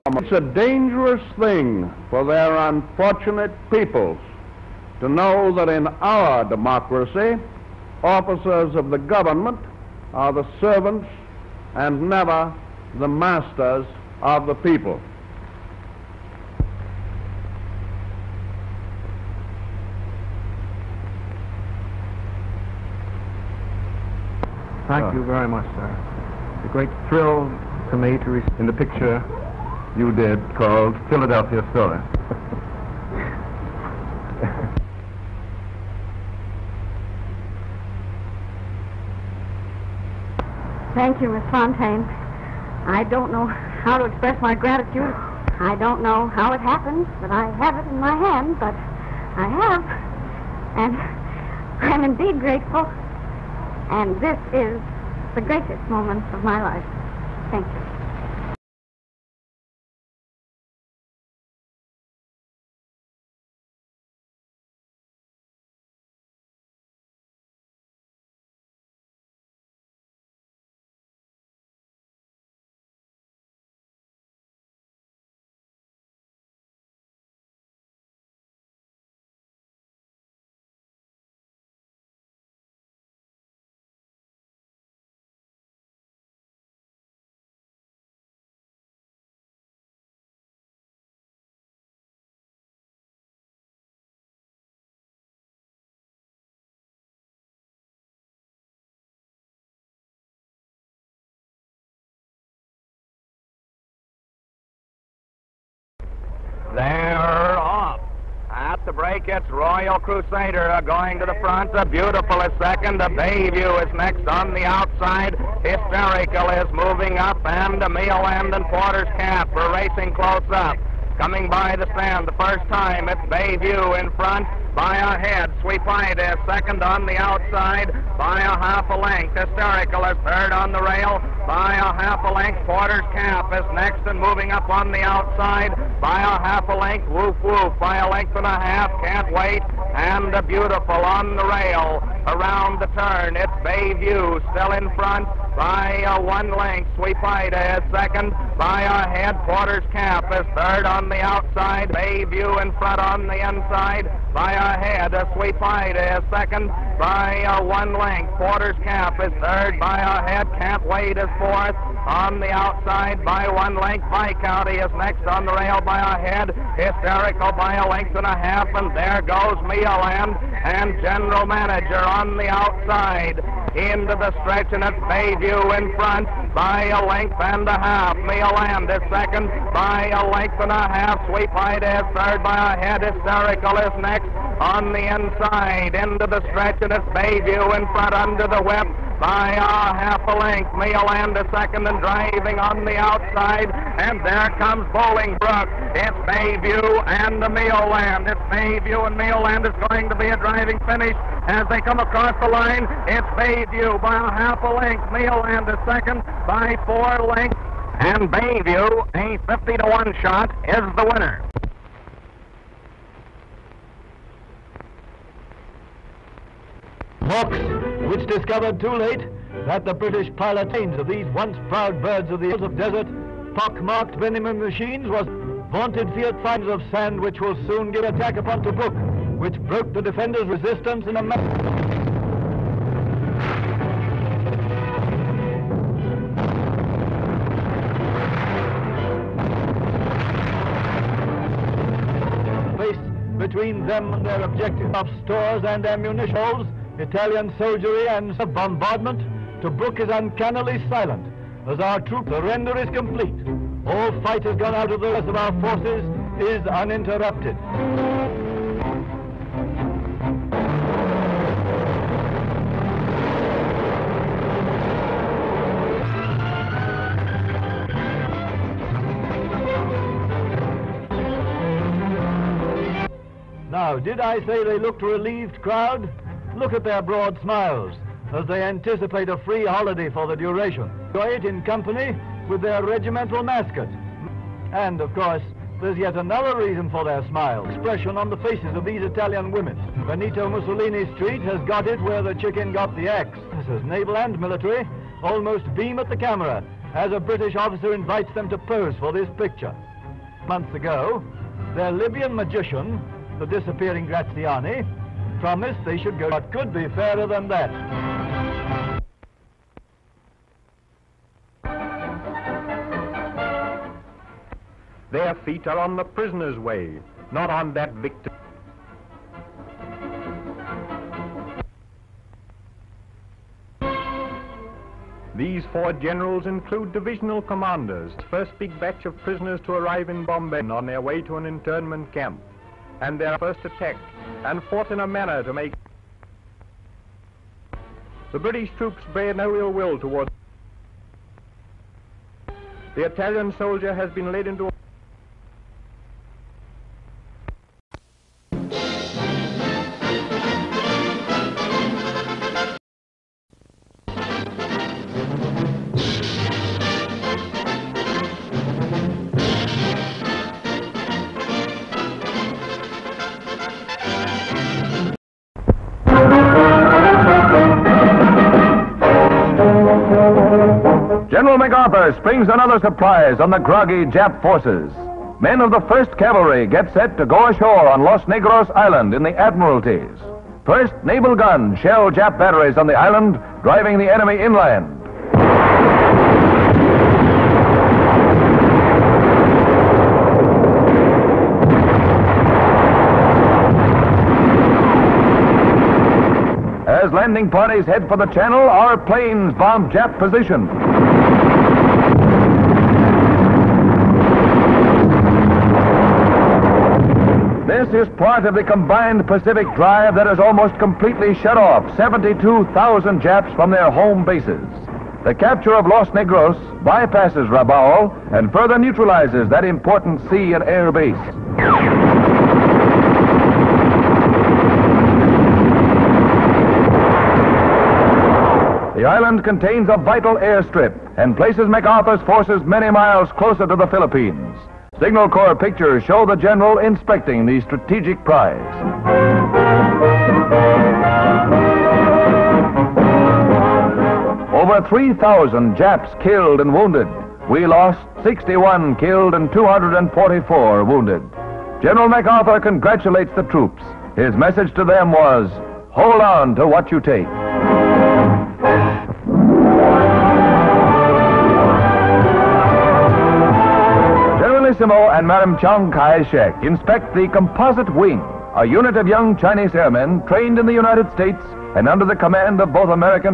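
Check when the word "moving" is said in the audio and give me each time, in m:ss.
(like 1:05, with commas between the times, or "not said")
1:56, 2:14.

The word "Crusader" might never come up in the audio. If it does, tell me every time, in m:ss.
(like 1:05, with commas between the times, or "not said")
1:49.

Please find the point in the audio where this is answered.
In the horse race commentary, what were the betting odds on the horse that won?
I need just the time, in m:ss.
3:29.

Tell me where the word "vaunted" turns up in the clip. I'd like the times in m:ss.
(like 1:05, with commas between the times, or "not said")
3:45.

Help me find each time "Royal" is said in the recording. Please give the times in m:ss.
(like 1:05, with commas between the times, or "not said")
1:49.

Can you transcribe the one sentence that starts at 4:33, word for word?
Now, did I say they looked a relieved crowd?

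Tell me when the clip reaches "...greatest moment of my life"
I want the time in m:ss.
0:55.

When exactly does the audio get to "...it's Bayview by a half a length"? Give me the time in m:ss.
3:23.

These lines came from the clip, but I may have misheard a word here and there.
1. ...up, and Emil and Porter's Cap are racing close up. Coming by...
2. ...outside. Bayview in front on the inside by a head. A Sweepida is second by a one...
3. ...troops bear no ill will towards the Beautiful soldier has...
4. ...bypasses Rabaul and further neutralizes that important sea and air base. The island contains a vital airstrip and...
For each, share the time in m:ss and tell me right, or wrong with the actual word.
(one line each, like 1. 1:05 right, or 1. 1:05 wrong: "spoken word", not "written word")
1. 1:57 right
2. 2:31 right
3. 5:38 wrong: "Italian", not "Beautiful"
4. 6:56 right.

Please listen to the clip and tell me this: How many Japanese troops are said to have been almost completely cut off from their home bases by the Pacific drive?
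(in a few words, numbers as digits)
72,000.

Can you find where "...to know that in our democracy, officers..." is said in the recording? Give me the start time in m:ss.
0:04.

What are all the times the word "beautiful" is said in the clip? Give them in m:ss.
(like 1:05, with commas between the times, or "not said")
1:51, 2:20.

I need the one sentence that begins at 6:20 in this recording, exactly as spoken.
First naval guns shell Jap batteries on the island, driving the enemy inland.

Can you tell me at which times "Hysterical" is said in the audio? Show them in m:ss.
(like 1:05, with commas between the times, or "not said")
1:55, 2:09, 2:46, 3:03.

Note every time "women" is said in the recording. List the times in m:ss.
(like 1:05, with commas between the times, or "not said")
4:49.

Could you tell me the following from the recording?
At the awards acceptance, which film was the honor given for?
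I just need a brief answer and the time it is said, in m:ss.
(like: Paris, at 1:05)
Philadelphia Story, at 0:31.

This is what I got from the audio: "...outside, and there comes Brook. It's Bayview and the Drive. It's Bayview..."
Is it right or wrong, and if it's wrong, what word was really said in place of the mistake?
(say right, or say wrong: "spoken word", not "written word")
wrong: "Mioland", not "Drive".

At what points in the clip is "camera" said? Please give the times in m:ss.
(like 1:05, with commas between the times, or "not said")
4:56.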